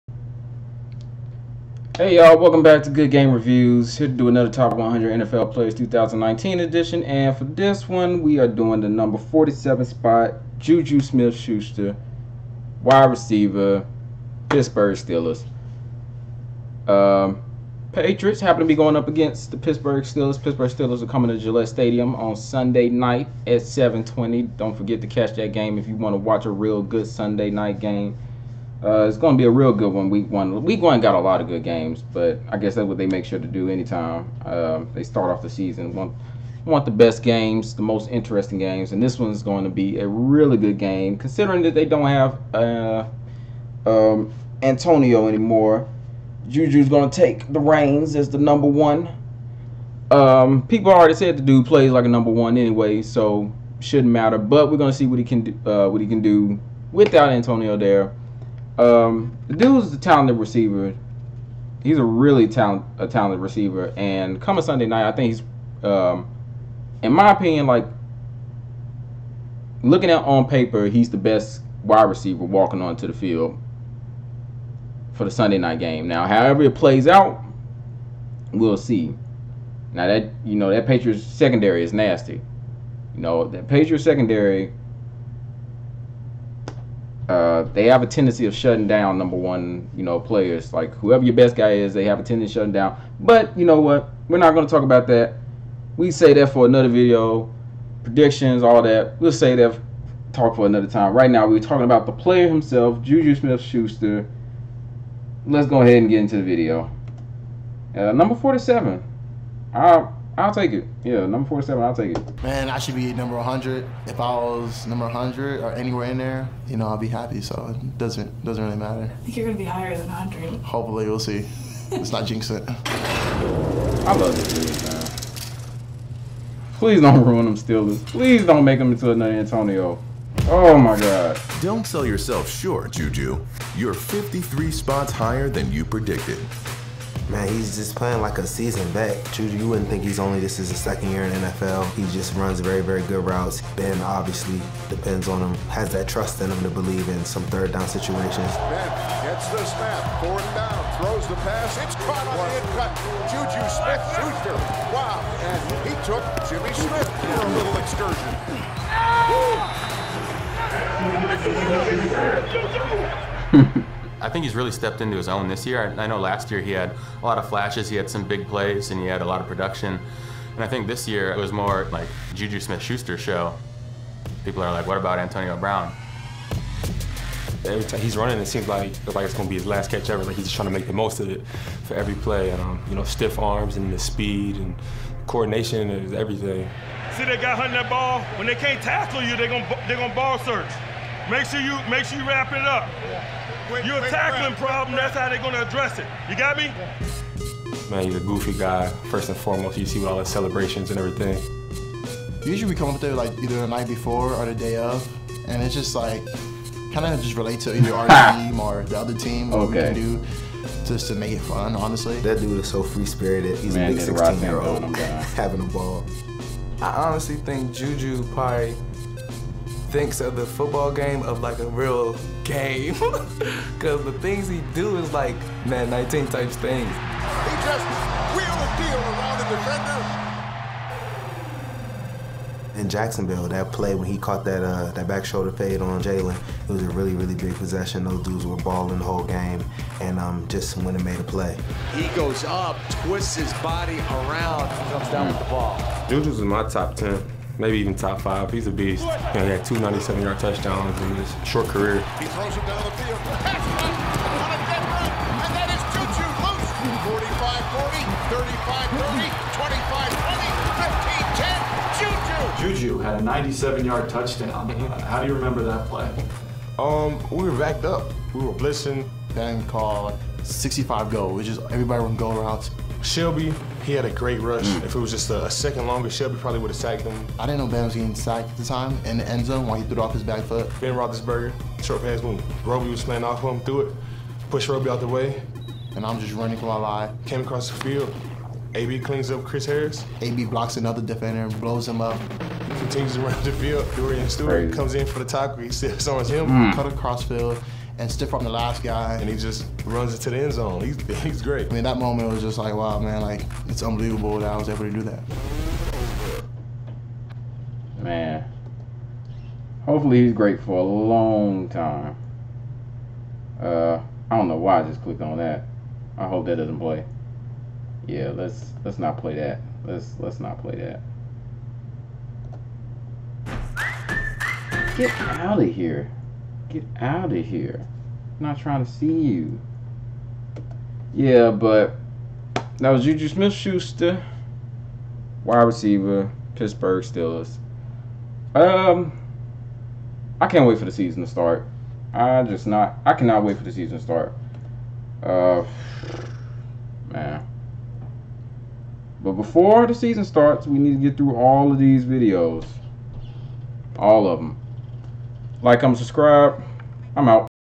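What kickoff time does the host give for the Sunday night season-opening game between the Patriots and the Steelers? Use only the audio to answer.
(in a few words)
7:20.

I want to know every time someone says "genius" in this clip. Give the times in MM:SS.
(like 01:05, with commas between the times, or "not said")
not said.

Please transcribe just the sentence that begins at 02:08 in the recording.
Please don't make them into another Antonio.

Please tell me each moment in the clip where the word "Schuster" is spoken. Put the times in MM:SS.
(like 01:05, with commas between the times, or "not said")
00:10, 01:43, 02:34, 02:52, 05:33.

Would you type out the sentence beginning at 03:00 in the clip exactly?
Like he's just trying to make the most of it for every play.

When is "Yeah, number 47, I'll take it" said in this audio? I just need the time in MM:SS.
01:51.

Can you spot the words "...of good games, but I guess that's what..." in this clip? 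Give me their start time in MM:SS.
00:31.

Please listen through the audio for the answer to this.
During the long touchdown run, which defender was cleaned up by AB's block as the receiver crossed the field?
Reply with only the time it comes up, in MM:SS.
04:49.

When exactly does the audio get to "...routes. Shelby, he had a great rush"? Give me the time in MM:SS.
04:32.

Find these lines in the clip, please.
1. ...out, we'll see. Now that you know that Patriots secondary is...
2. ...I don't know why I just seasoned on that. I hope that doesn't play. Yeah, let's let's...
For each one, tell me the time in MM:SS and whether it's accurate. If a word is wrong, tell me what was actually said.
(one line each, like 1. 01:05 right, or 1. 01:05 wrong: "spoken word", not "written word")
1. 01:17 right
2. 05:14 wrong: "clicked", not "seasoned".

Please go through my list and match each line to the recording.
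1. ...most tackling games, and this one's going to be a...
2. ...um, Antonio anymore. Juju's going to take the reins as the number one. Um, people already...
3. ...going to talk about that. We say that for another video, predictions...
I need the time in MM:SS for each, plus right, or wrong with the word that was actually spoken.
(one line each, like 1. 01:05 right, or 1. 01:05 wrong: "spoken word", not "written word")
1. 00:37 wrong: "interesting", not "tackling"
2. 00:43 right
3. 01:34 right.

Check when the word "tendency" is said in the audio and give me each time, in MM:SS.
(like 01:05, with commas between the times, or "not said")
01:28, 01:32.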